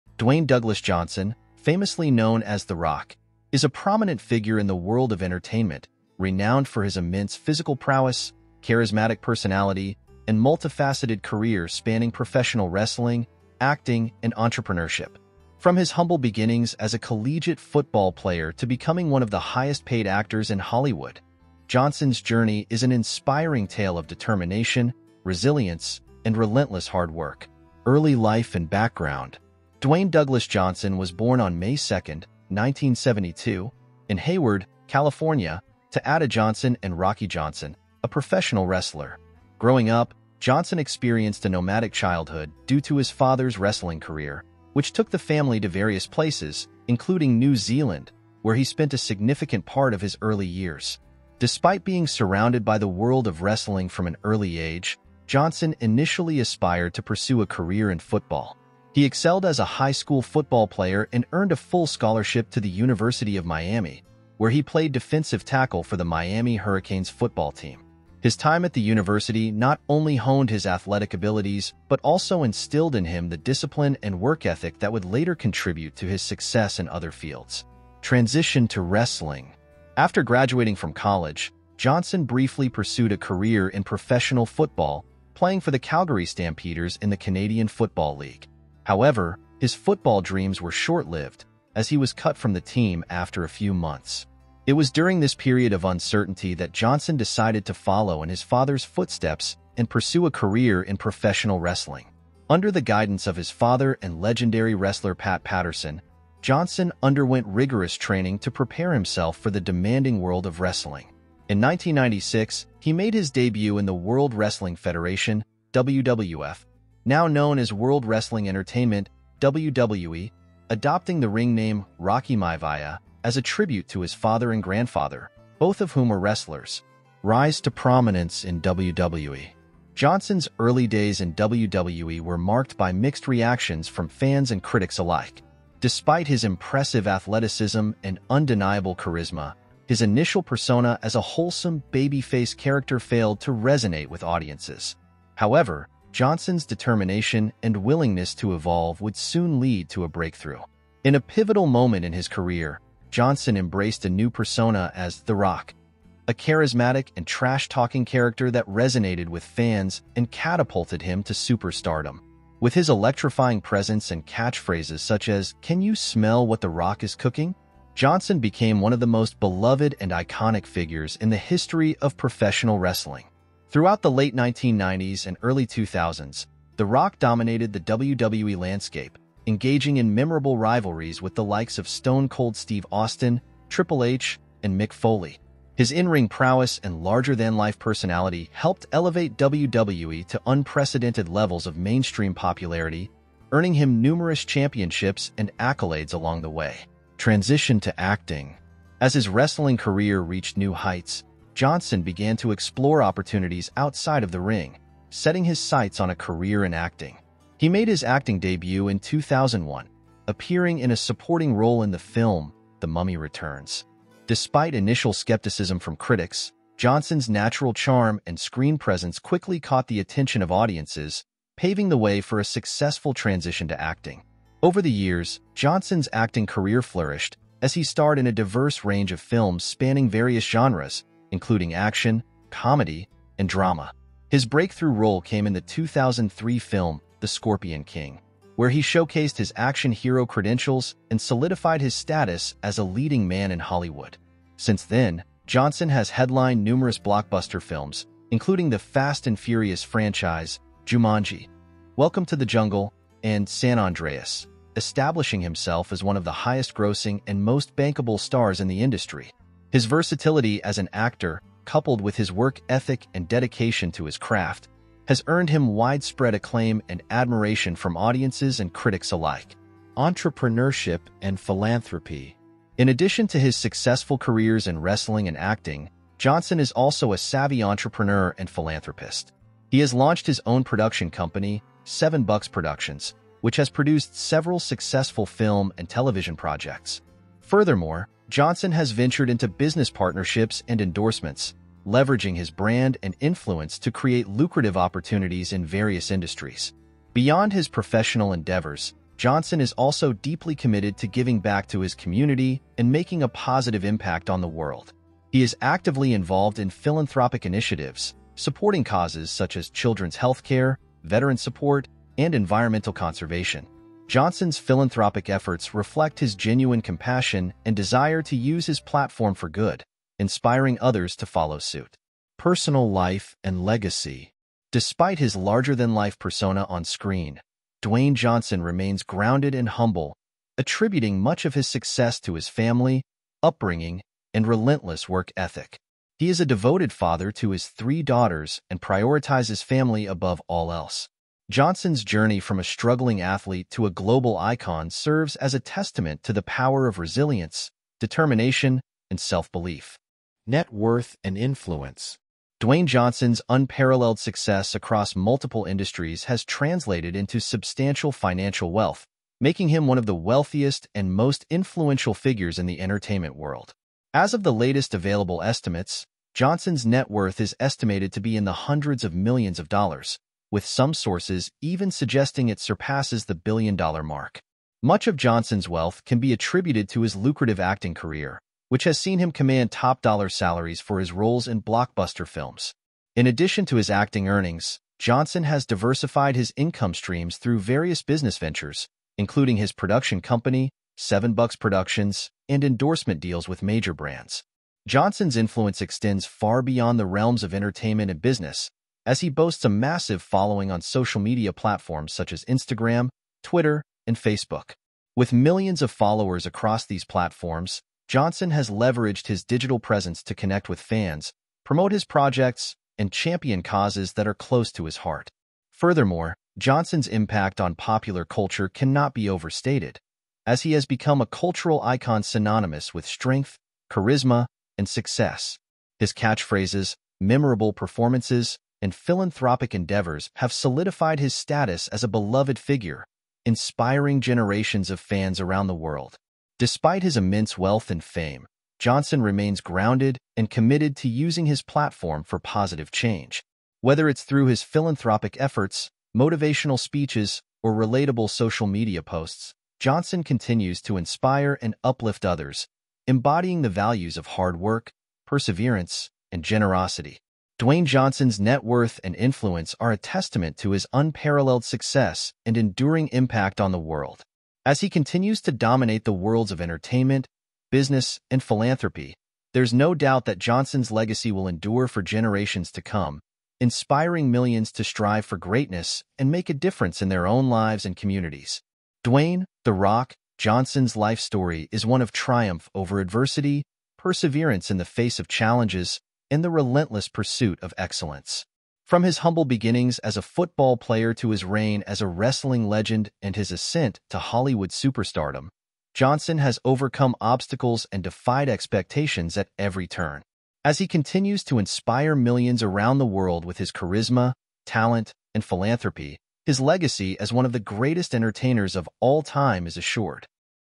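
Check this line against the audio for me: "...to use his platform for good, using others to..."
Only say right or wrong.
wrong.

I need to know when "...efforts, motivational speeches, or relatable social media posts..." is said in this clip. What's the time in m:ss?
7:25.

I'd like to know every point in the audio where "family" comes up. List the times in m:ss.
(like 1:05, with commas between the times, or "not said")
0:45, 5:32, 5:39.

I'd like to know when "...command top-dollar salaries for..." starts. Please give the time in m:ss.
6:19.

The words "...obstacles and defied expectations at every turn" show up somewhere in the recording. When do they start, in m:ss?
8:17.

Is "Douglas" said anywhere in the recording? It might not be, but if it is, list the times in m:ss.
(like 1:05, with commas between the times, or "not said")
0:00, 0:30.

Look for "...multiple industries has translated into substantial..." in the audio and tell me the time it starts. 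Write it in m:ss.
5:55.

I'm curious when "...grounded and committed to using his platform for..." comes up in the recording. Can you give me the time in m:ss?
7:19.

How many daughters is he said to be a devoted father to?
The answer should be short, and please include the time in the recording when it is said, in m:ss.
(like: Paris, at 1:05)
3, at 5:37.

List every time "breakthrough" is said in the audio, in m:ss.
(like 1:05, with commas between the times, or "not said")
2:30, 3:54.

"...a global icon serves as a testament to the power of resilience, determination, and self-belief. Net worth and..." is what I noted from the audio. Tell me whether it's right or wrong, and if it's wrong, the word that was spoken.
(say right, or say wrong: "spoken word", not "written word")
right.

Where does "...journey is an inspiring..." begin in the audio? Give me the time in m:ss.
0:22.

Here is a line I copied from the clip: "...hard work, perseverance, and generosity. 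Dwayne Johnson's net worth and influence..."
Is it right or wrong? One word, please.
right.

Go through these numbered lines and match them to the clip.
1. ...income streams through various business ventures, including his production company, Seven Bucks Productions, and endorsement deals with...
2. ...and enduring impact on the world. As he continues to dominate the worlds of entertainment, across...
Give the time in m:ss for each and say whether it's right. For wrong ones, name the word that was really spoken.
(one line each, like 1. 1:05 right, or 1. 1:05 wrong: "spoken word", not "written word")
1. 6:26 right
2. 7:42 wrong: "business", not "across".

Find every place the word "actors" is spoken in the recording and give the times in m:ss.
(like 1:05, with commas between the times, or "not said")
0:20, 4:20.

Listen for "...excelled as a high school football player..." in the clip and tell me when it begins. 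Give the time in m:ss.
0:59.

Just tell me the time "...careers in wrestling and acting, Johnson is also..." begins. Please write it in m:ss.
4:34.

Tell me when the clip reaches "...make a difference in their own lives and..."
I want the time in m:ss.
7:56.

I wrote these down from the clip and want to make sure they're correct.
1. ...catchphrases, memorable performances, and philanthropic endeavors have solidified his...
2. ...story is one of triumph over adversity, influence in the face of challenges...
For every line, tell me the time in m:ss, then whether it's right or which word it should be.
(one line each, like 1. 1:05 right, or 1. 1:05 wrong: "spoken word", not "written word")
1. 7:06 right
2. 8:01 wrong: "perseverance", not "influence".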